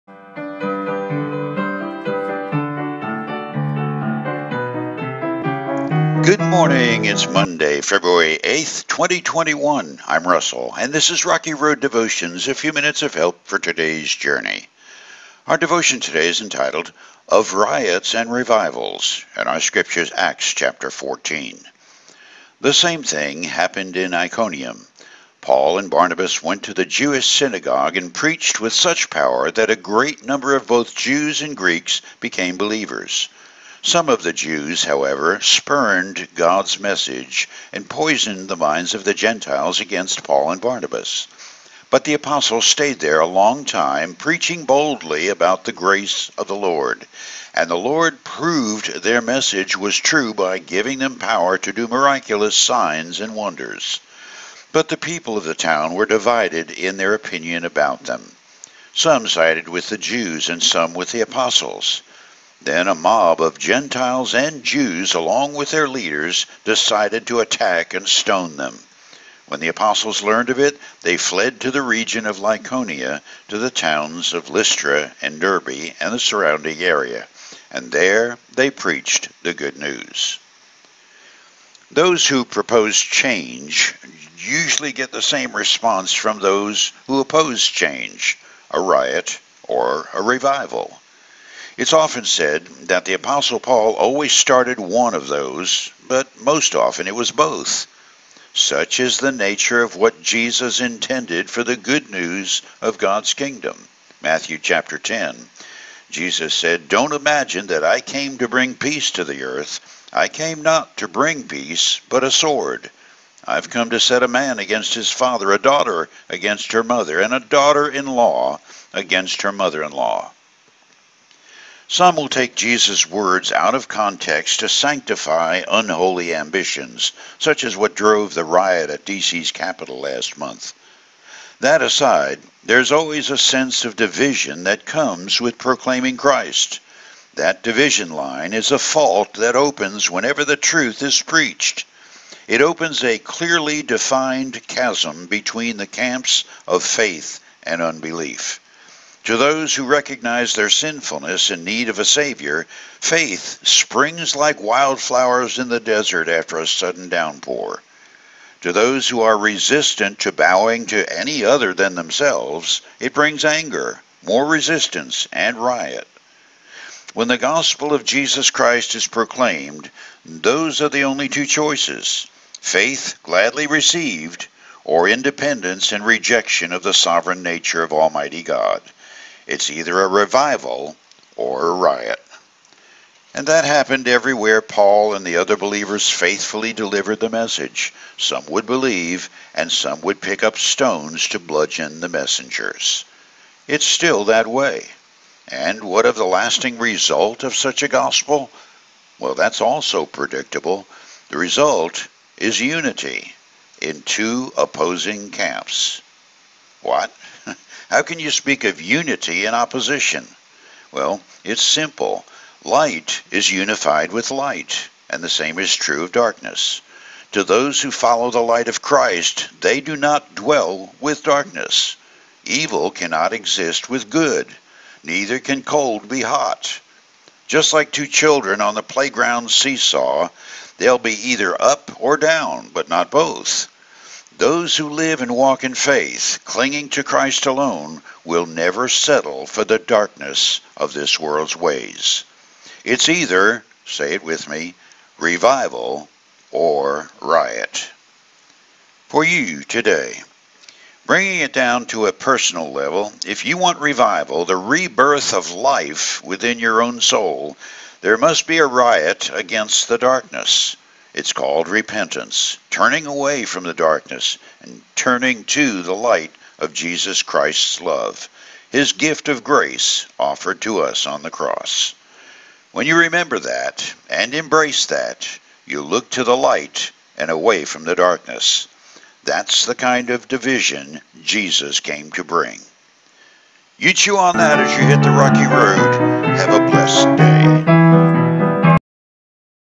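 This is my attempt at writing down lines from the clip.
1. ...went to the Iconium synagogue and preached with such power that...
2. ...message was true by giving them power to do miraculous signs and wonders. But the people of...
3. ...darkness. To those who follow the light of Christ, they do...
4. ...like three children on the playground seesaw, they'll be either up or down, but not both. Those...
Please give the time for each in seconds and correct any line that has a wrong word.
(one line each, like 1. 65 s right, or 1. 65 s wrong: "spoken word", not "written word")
1. 26 s wrong: "Jewish", not "Iconium"
2. 49 s right
3. 216 s right
4. 227 s wrong: "two", not "three".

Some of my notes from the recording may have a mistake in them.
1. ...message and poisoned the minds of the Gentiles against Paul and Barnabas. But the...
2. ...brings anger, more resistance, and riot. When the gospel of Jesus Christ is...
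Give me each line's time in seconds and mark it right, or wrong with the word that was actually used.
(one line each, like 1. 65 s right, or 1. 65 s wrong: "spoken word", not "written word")
1. 36 s right
2. 163 s right.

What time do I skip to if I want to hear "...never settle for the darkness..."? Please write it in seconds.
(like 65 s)
238 s.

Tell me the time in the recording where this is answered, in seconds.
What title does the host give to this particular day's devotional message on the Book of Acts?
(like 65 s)
17 s.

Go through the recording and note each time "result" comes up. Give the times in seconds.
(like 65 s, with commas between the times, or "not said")
196 s, 201 s.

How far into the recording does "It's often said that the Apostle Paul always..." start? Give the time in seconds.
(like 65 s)
91 s.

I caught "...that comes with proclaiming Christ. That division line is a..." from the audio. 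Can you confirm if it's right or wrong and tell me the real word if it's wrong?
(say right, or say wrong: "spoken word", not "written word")
right.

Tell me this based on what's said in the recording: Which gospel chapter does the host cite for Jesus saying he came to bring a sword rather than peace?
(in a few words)
Matthew chapter 10.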